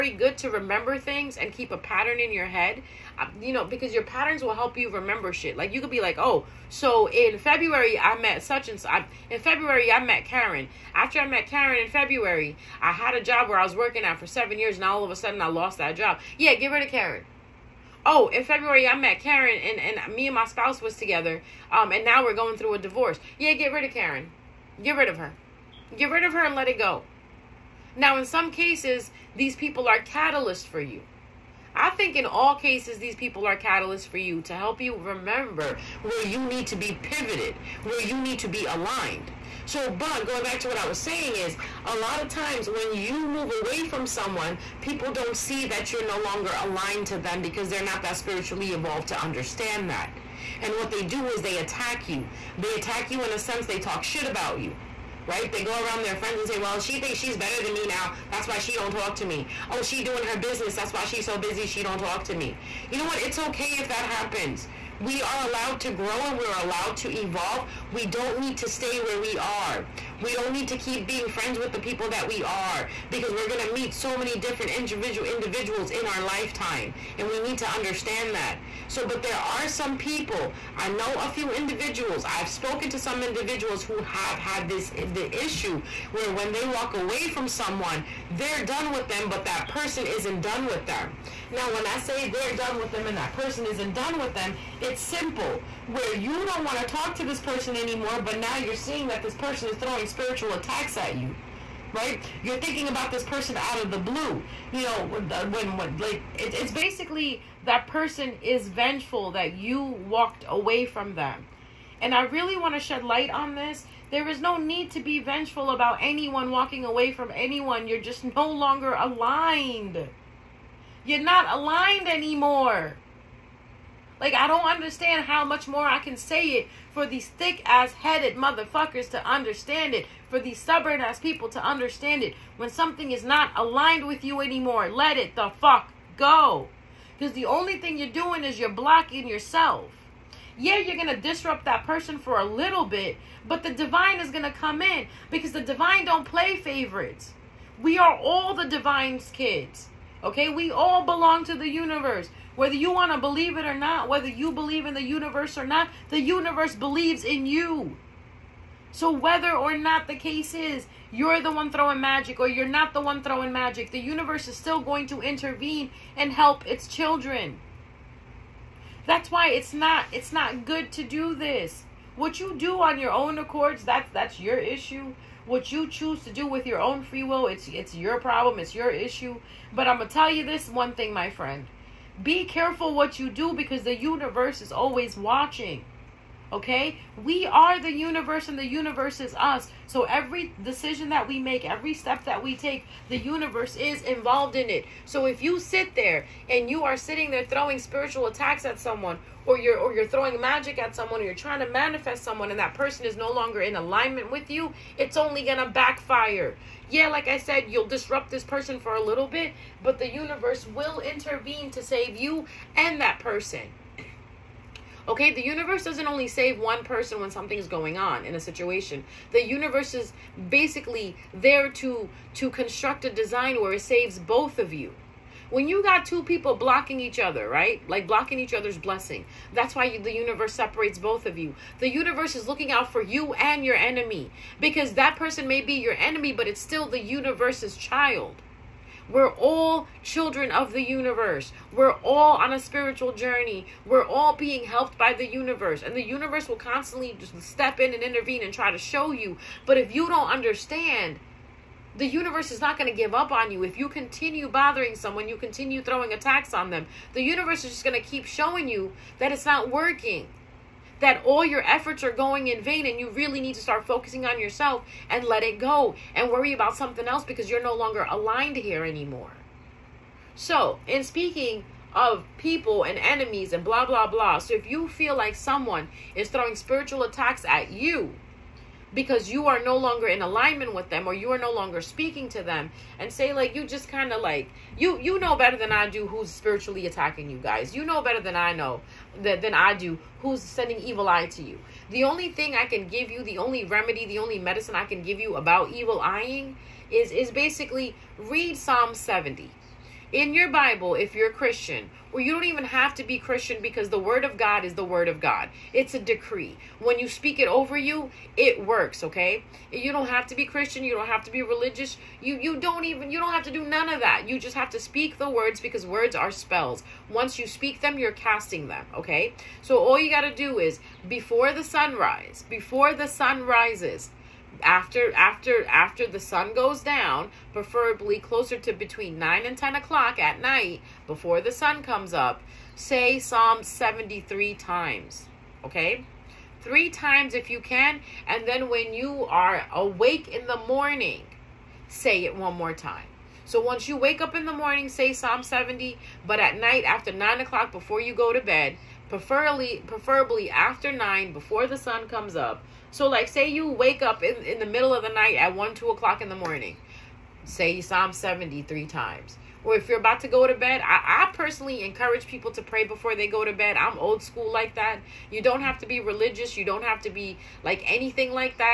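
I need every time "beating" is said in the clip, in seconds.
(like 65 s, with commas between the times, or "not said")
not said.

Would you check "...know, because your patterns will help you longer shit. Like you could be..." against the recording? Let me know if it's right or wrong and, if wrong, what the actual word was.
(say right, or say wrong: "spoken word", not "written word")
wrong: "remember", not "longer".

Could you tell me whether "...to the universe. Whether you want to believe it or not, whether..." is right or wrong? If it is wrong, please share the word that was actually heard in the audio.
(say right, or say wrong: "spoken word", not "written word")
right.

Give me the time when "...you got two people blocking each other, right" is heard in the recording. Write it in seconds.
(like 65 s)
225 s.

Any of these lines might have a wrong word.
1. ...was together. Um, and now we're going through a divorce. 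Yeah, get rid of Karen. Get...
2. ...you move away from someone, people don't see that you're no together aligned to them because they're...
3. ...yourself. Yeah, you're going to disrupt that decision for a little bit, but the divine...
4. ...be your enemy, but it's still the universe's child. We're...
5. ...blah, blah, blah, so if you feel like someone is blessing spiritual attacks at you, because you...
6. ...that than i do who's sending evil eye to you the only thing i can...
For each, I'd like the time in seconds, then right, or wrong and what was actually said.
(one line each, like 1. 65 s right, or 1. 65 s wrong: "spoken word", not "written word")
1. 20 s right
2. 42 s wrong: "longer", not "together"
3. 139 s wrong: "person", not "decision"
4. 235 s right
5. 273 s wrong: "throwing", not "blessing"
6. 289 s right.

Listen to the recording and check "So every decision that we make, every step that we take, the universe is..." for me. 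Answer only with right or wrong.
right.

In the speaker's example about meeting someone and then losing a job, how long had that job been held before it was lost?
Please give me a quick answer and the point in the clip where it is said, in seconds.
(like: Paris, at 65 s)
7 years, at 14 s.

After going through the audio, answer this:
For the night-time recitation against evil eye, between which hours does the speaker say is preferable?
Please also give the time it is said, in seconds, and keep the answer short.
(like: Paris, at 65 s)
9 and 10 o'clock, at 328 s.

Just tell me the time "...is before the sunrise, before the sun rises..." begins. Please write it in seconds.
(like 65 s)
320 s.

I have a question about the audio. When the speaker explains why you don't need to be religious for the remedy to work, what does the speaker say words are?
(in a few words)
spells.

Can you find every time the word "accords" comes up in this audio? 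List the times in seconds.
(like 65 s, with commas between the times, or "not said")
173 s.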